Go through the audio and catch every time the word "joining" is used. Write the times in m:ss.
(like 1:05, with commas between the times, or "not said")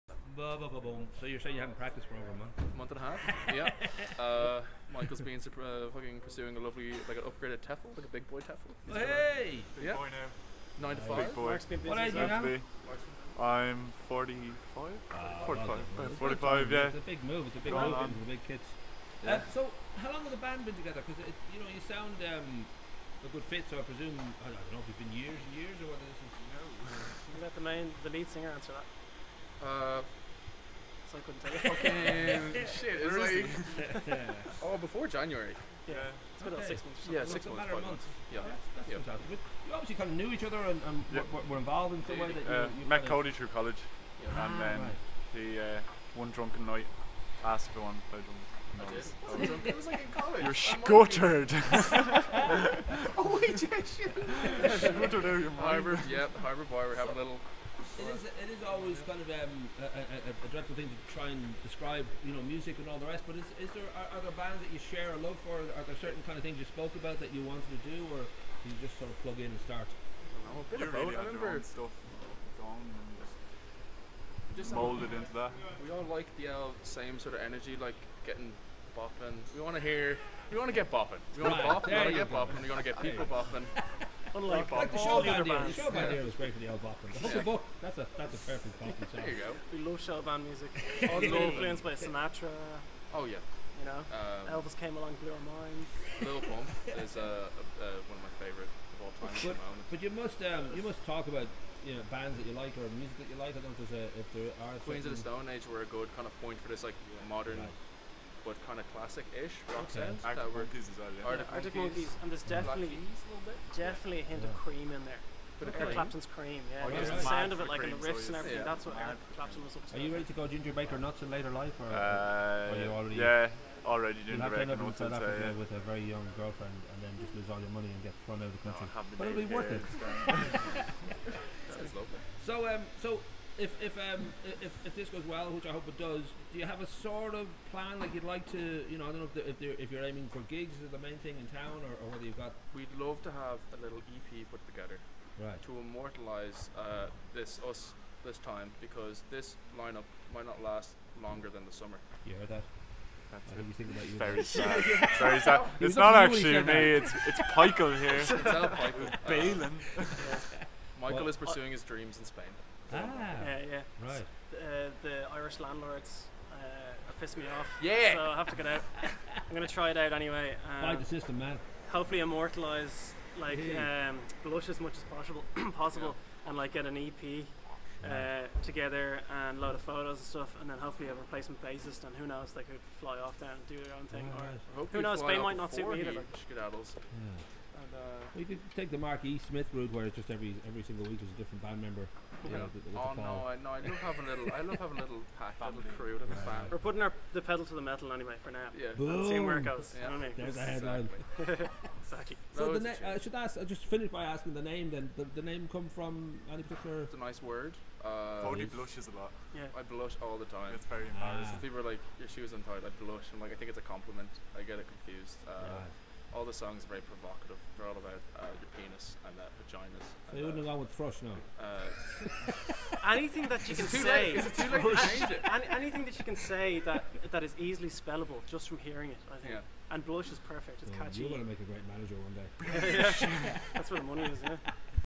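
not said.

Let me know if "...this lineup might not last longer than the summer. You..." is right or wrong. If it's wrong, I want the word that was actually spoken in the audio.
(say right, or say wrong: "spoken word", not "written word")
right.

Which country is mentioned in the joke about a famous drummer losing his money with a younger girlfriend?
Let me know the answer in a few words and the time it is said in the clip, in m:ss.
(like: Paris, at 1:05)
South Africa, at 2:04.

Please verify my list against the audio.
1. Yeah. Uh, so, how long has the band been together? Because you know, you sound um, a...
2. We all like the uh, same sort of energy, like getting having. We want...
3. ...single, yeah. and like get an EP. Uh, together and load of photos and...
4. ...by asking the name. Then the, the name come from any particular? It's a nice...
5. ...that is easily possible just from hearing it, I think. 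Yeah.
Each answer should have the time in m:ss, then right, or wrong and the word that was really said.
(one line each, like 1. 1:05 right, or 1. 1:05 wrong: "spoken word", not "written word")
1. 0:19 right
2. 1:15 wrong: "bopping", not "having"
3. 2:55 wrong: "possible", not "single"
4. 3:24 right
5. 3:47 wrong: "spellable", not "possible".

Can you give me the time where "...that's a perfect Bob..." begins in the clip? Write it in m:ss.
1:28.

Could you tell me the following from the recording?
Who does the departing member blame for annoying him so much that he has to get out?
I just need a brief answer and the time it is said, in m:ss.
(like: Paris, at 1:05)
Irish landlords, at 2:45.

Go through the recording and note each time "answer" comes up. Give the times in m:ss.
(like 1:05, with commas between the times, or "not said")
0:28.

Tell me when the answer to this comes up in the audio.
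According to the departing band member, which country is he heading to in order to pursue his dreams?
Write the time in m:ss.
2:42.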